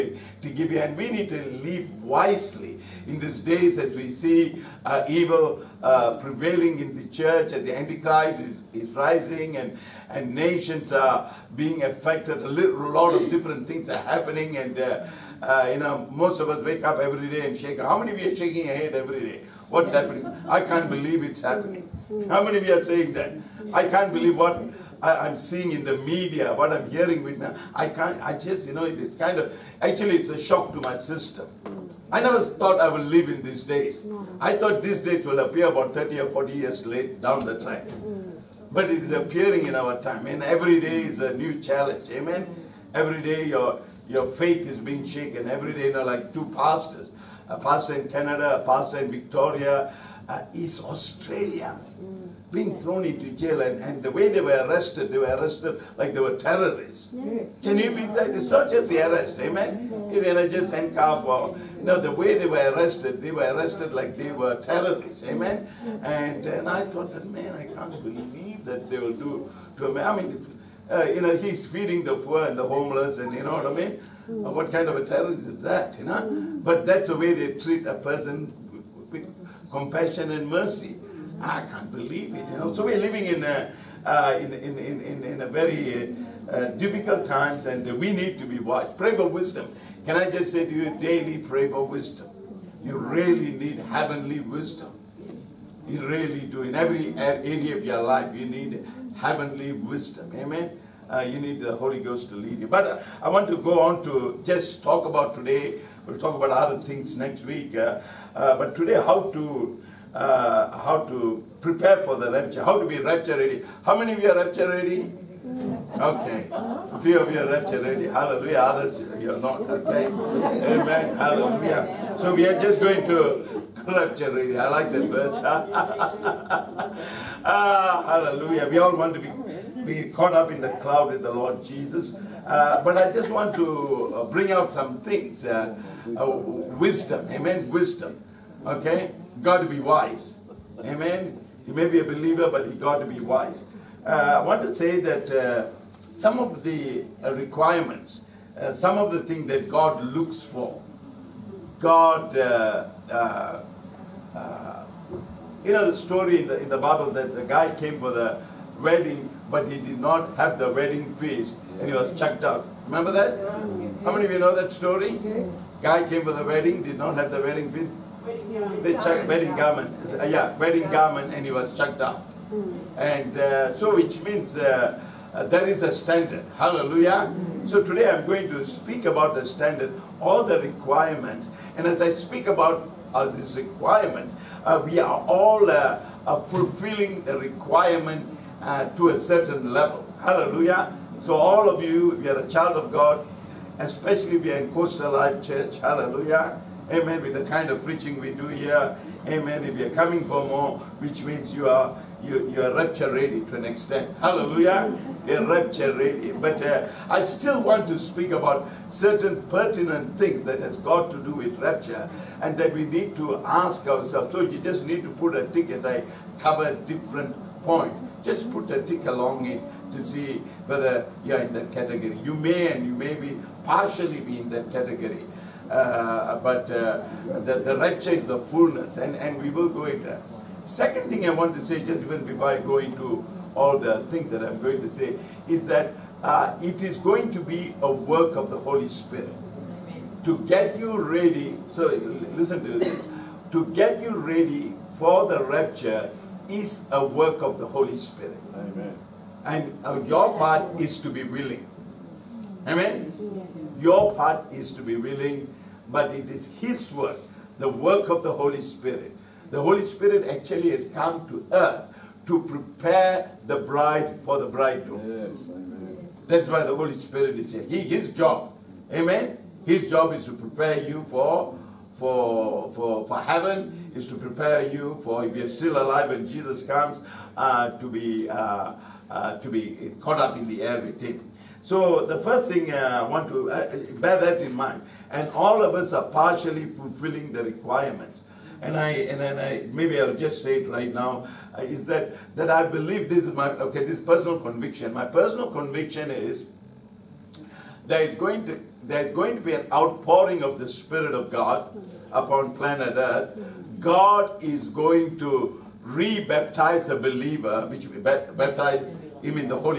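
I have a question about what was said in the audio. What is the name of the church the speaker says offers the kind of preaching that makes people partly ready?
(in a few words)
Coast Alive Church.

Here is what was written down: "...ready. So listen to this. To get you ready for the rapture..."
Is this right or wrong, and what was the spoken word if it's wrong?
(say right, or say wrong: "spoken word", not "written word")
right.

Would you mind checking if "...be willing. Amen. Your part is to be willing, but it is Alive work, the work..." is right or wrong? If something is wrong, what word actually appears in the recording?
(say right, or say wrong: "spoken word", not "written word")
wrong: "His", not "Alive".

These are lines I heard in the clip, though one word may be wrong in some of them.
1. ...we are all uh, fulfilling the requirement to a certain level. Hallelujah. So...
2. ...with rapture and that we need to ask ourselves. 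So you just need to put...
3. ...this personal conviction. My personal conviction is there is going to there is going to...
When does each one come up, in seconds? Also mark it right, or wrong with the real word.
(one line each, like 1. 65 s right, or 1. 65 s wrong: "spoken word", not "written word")
1. 184 s right
2. 211 s right
3. 293 s right.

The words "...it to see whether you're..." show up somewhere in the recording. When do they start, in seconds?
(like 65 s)
219 s.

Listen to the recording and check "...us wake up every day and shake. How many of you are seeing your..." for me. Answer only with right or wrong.
wrong.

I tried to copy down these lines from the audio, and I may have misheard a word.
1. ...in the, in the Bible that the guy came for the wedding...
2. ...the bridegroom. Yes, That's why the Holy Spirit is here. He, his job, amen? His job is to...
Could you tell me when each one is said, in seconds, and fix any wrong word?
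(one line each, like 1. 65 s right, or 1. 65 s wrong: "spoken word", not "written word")
1. 156 s right
2. 264 s right.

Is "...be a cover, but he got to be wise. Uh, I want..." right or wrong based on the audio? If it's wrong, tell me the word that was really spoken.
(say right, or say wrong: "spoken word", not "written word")
wrong: "believer", not "cover".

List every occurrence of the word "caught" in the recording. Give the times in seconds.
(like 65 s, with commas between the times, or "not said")
130 s, 279 s.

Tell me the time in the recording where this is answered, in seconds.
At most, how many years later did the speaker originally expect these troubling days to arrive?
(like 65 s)
36 s.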